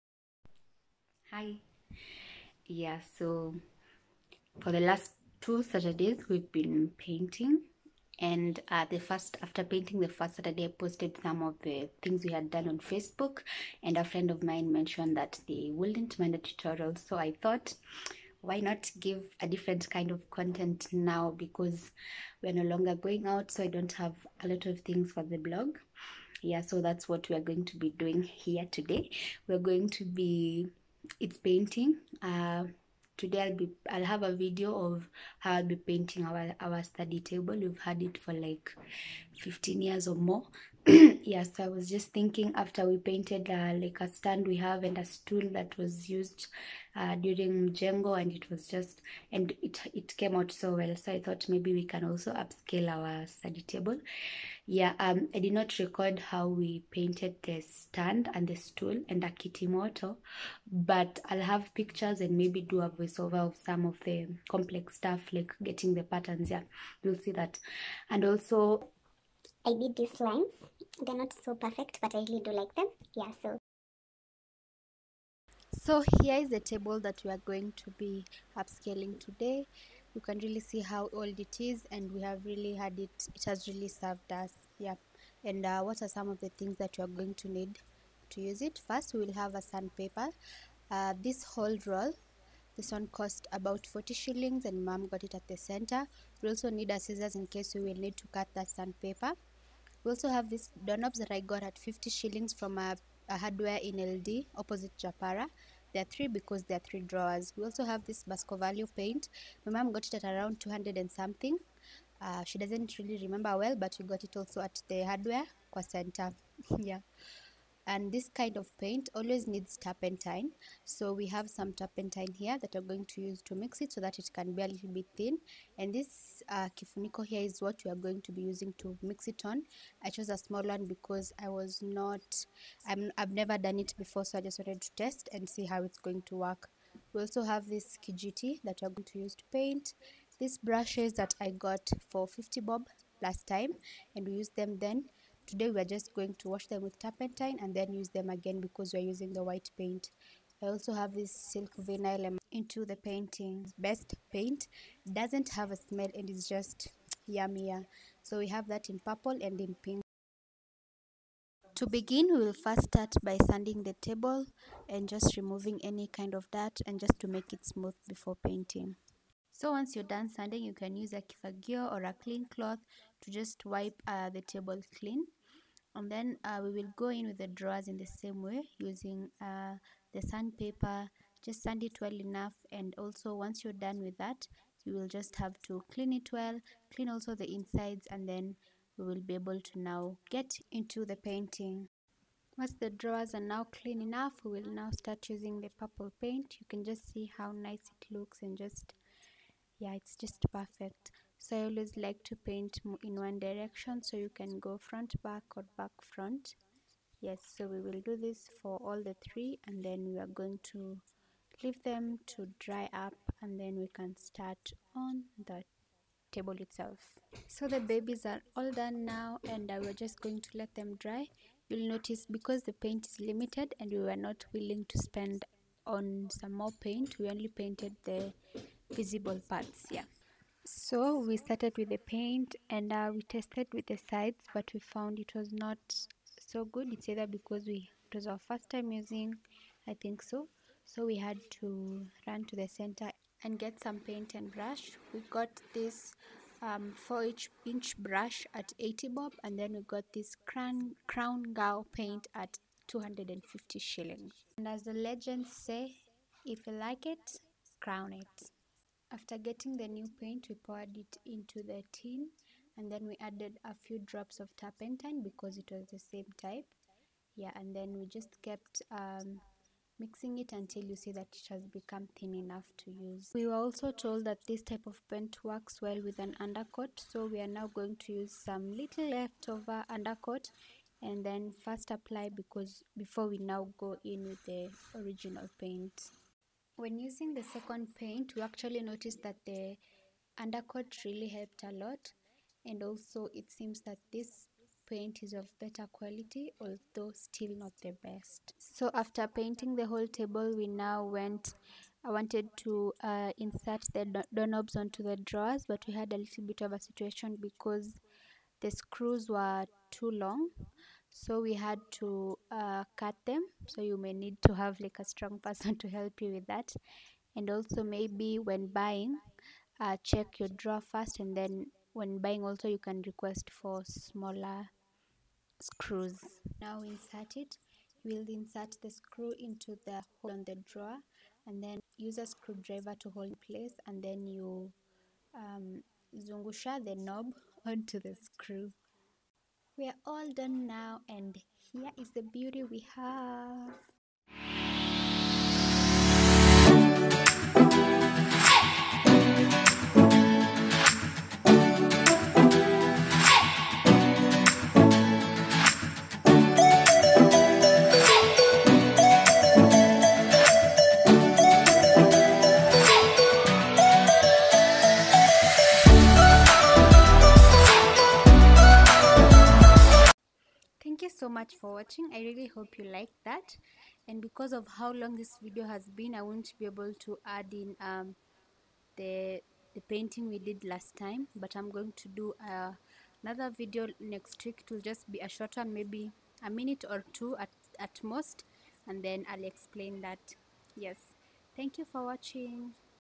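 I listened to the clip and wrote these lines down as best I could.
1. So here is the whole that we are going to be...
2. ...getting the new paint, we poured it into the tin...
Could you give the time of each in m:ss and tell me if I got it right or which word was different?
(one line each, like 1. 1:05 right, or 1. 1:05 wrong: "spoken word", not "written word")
1. 1:15 wrong: "table", not "whole"
2. 4:19 right.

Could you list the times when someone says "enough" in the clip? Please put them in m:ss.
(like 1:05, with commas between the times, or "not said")
3:02, 3:14, 4:32.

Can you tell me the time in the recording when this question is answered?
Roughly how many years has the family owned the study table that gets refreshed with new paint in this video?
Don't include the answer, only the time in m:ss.
0:39.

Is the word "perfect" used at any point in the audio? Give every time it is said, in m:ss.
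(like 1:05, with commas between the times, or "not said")
1:11, 3:20.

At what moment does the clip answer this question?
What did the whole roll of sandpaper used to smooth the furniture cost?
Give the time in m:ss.
1:33.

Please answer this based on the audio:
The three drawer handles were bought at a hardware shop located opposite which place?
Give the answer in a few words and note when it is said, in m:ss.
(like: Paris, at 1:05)
Japara, at 1:44.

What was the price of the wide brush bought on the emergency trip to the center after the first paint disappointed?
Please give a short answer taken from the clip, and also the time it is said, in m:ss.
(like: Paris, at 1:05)
80 bob, at 4:08.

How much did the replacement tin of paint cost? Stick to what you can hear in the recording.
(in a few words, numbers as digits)
250 shillings.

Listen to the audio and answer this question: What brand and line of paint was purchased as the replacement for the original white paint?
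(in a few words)
Crown Ngao.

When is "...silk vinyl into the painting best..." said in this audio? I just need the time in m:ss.
2:31.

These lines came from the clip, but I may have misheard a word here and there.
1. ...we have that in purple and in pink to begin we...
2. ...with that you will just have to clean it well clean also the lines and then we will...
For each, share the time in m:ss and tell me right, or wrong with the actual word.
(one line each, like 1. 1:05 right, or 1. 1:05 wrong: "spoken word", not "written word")
1. 2:38 right
2. 3:04 wrong: "insides", not "lines".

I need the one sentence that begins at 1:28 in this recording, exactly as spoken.
First, we will have a sandpaper.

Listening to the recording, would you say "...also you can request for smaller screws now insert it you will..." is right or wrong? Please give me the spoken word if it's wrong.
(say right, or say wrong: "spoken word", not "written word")
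right.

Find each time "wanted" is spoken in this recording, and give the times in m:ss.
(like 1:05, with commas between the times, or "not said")
2:14, 5:02.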